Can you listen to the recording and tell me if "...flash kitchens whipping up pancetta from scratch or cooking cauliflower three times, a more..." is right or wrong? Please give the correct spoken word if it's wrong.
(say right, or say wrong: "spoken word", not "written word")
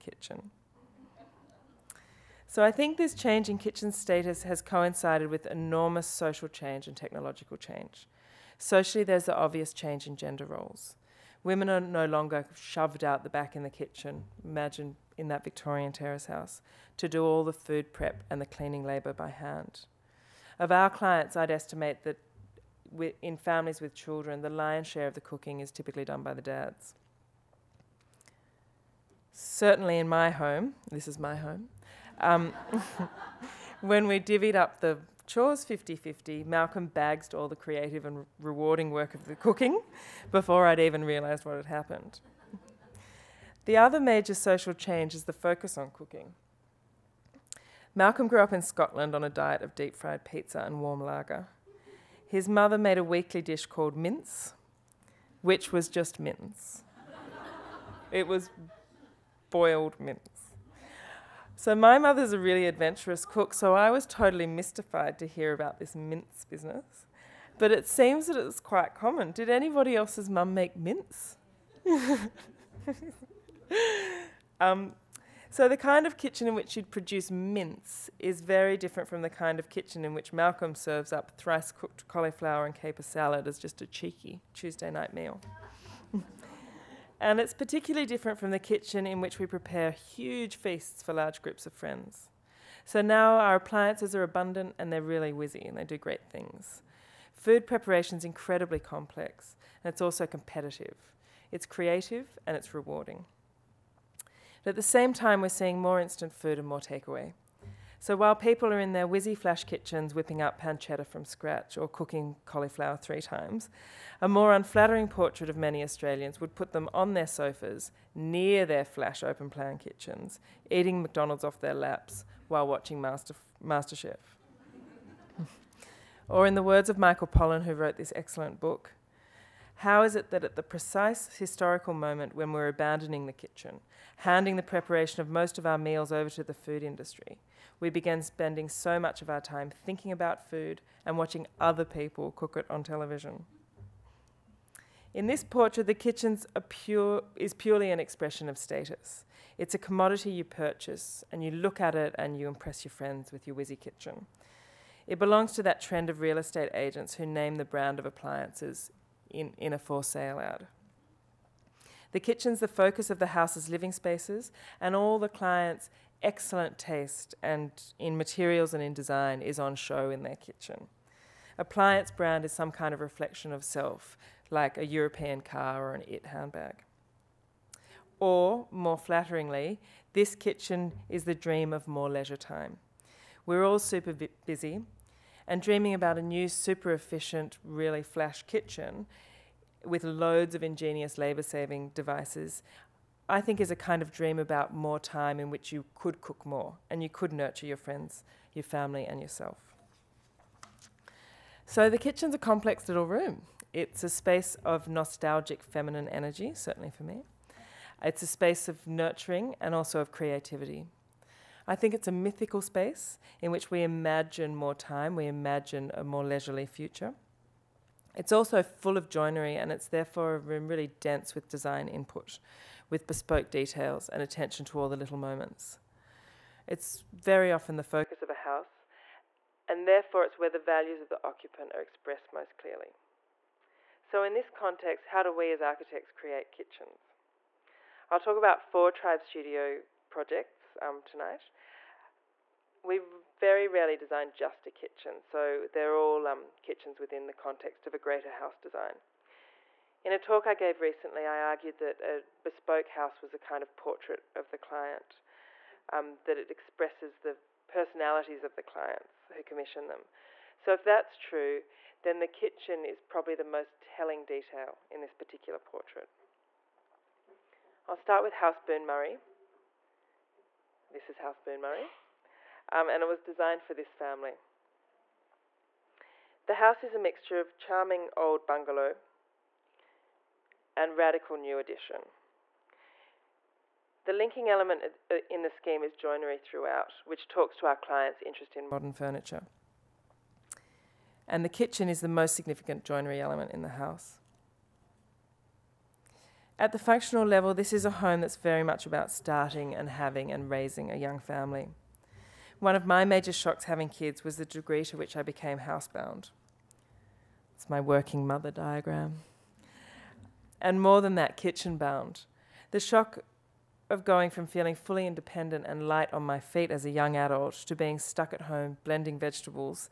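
right.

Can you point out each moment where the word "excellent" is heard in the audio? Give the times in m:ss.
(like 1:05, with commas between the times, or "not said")
2:08, 2:46.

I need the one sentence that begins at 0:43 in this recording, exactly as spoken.
the other major social change is the focus on cooking.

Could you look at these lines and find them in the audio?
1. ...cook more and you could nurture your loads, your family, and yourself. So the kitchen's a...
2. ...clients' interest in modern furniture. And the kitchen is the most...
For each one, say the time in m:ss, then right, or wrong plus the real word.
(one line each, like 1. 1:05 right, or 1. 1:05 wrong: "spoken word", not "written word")
1. 3:16 wrong: "friends", not "loads"
2. 4:47 right.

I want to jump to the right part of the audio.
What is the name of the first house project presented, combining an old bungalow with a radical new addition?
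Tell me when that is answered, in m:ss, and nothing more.
4:31.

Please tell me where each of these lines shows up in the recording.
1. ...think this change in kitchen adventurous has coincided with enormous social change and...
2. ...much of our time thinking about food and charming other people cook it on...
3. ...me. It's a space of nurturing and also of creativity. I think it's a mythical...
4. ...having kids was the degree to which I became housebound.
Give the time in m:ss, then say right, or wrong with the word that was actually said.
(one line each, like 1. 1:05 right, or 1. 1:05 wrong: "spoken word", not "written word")
1. 0:02 wrong: "status", not "adventurous"
2. 2:18 wrong: "watching", not "charming"
3. 3:27 right
4. 5:03 right.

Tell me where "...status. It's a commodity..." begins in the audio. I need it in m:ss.
2:28.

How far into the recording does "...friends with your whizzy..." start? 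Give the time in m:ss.
2:32.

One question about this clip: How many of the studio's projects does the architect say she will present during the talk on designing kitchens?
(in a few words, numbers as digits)
4.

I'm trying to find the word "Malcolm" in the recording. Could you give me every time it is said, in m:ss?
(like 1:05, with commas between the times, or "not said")
0:36, 0:47, 1:20.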